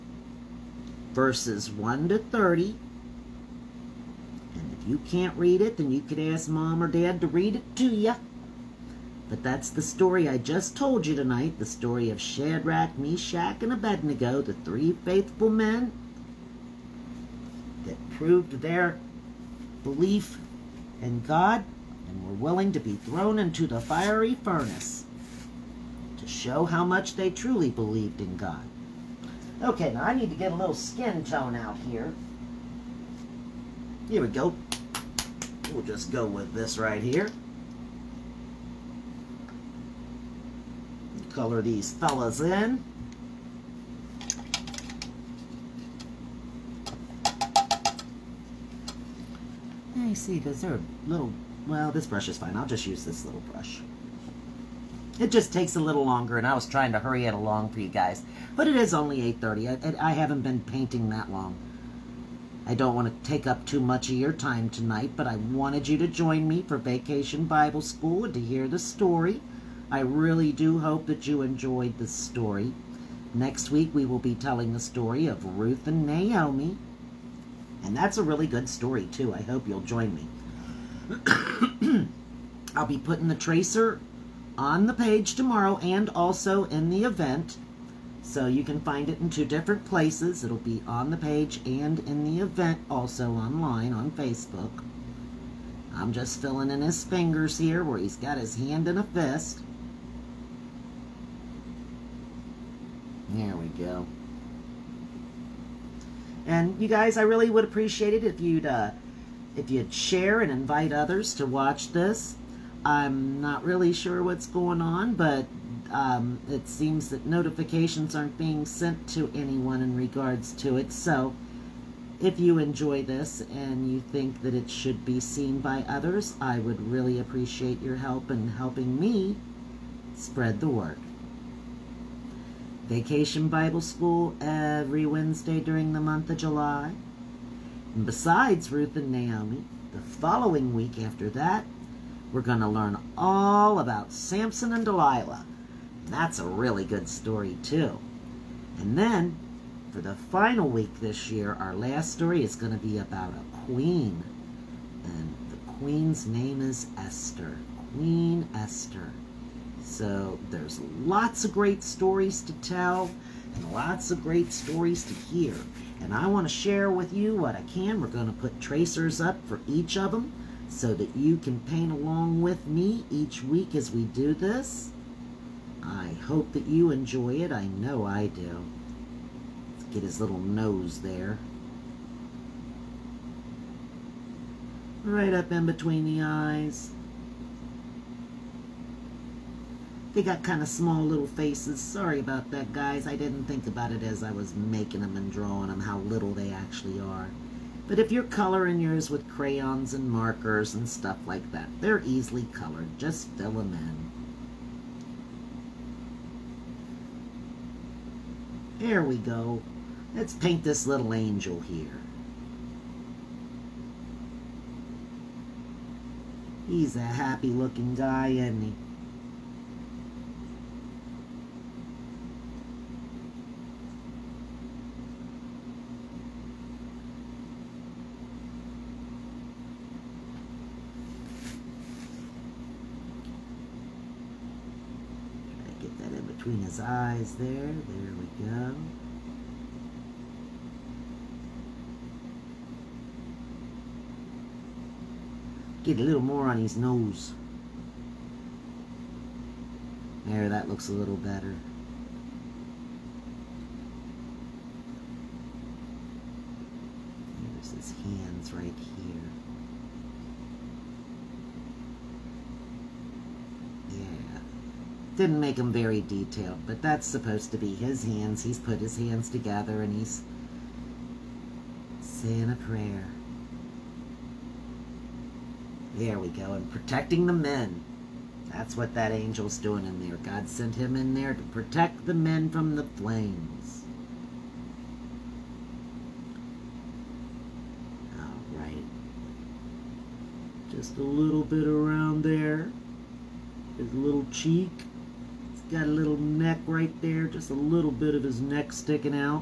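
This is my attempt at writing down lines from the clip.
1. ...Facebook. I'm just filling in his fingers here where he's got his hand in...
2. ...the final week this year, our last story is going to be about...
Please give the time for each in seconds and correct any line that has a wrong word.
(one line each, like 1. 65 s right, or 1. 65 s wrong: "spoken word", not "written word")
1. 94 s right
2. 150 s right.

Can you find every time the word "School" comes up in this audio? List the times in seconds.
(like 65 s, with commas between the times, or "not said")
67 s, 133 s.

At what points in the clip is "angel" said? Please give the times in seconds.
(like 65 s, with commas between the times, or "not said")
211 s, 279 s.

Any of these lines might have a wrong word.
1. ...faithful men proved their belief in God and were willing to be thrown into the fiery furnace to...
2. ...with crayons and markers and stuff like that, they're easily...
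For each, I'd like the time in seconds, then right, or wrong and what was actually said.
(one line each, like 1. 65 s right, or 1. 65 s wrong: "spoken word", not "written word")
1. 15 s right
2. 199 s right.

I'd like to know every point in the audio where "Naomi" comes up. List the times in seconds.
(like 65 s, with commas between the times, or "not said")
76 s, 139 s.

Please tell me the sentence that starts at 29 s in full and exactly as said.
Okay, now I need to get a little skin tone out here.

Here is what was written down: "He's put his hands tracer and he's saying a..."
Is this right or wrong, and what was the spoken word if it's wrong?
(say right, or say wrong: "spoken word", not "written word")
wrong: "together", not "tracer".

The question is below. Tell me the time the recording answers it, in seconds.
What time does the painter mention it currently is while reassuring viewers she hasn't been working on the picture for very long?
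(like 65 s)
59 s.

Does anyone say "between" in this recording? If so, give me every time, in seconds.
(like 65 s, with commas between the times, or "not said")
185 s.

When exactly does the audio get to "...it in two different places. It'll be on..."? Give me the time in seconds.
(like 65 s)
89 s.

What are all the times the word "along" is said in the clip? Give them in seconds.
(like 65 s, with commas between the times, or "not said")
57 s, 171 s.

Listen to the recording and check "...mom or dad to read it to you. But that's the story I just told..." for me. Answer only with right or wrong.
right.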